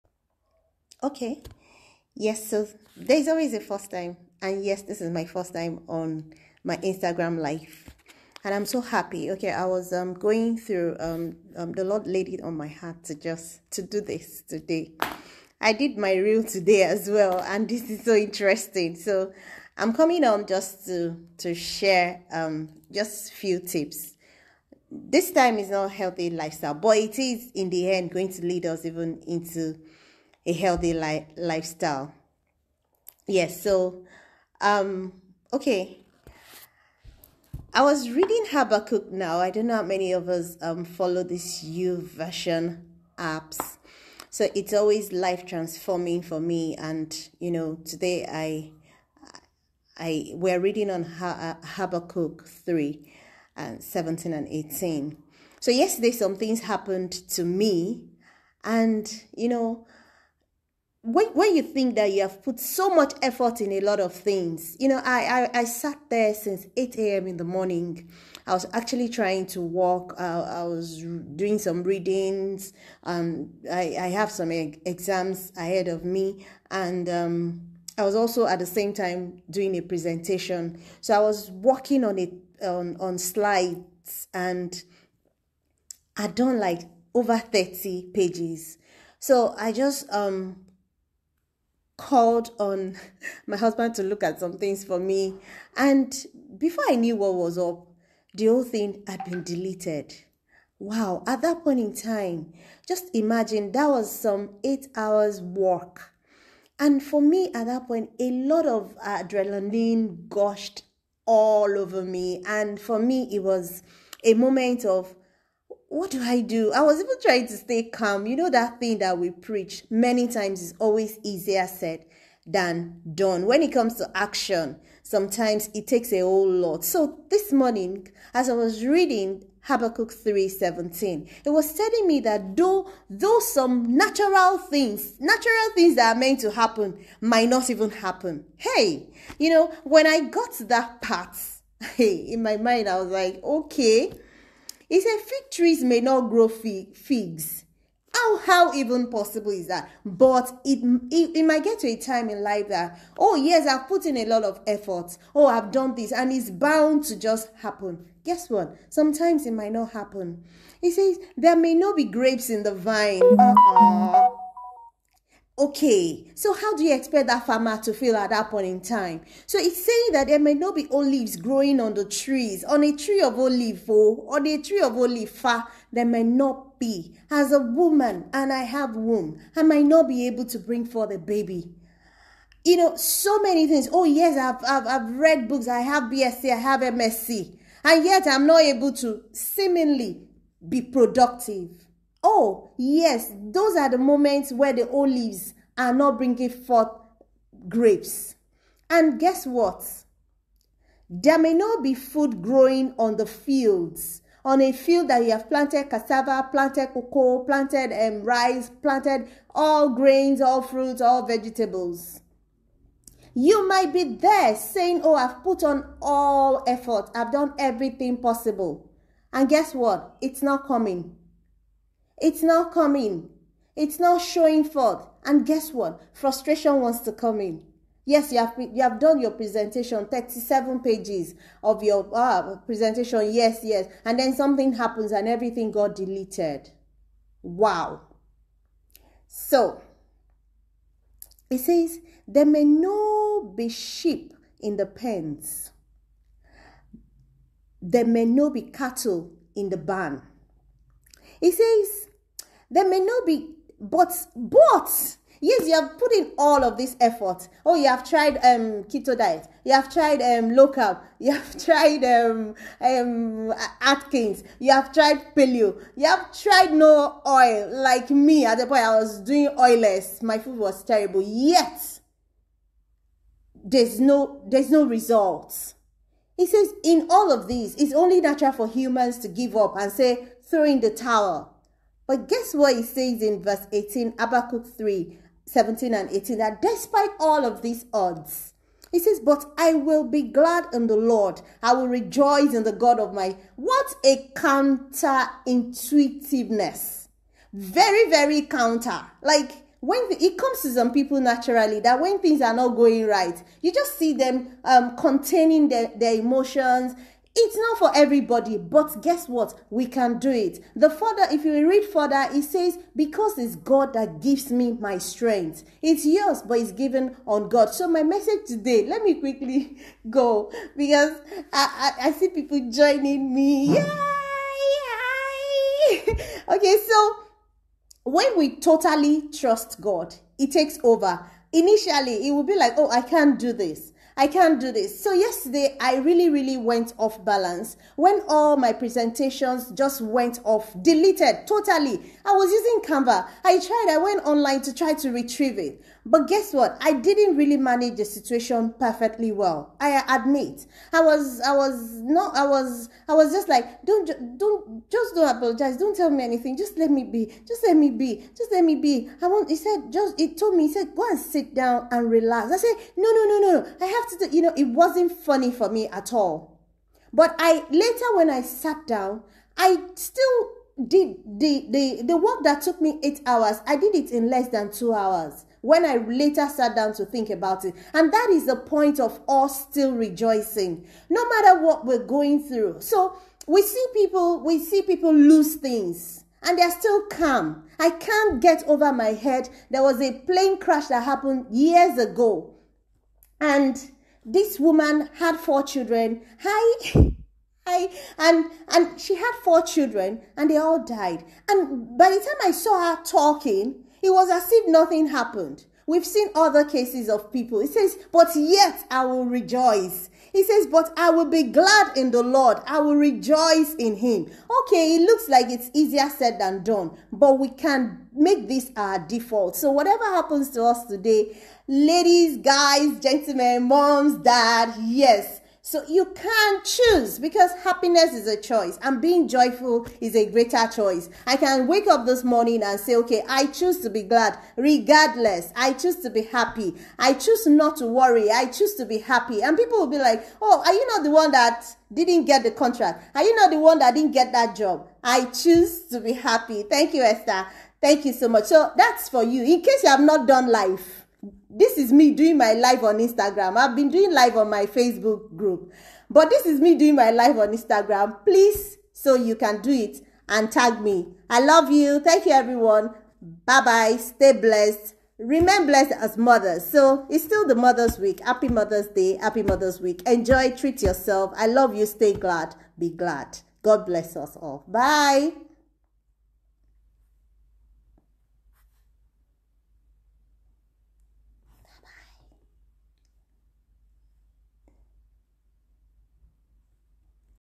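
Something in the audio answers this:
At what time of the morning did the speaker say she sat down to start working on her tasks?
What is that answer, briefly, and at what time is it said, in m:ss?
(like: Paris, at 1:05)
8 a.m., at 1:06.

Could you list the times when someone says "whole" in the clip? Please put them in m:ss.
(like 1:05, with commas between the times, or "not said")
1:38, 2:06.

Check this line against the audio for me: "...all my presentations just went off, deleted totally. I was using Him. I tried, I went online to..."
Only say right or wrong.
wrong.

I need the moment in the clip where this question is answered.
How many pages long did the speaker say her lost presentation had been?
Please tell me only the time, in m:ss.
3:50.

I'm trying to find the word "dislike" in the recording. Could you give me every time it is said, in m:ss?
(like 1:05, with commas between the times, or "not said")
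not said.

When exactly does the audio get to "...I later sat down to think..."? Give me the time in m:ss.
6:15.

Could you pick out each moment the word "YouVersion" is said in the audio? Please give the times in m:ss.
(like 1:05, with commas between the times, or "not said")
0:41.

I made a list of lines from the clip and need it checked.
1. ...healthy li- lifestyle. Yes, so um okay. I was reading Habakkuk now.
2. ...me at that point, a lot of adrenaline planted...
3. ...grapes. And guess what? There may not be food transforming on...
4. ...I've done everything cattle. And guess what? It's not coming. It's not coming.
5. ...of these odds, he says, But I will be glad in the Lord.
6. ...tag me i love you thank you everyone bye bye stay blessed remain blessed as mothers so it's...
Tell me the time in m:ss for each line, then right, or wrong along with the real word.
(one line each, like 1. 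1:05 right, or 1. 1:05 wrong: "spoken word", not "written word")
1. 0:30 right
2. 1:47 wrong: "gushed", not "planted"
3. 3:17 wrong: "growing", not "transforming"
4. 3:37 wrong: "possible", not "cattle"
5. 4:47 right
6. 7:40 right.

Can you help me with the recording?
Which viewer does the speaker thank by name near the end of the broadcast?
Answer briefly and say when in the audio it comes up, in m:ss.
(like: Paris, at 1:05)
Esther, at 7:27.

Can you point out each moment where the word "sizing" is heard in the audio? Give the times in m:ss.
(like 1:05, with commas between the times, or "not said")
not said.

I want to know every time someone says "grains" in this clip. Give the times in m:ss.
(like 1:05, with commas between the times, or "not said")
3:29.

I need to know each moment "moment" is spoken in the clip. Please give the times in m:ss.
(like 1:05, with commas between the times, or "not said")
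1:54, 3:13.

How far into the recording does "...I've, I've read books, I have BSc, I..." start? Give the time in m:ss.
3:04.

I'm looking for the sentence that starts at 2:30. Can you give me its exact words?
But it, it, it might get to a time in life that, oh, yes, I've put in a lot of effort.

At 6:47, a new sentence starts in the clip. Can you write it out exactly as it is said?
It says, But yet I will rejoice He says, But I will be glad in the Lord, I will rejoice in Him.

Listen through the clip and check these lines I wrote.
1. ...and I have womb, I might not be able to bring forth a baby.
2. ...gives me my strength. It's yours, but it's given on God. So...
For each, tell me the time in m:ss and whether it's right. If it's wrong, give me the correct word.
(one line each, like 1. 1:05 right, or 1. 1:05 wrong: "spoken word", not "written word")
1. 2:58 right
2. 5:14 right.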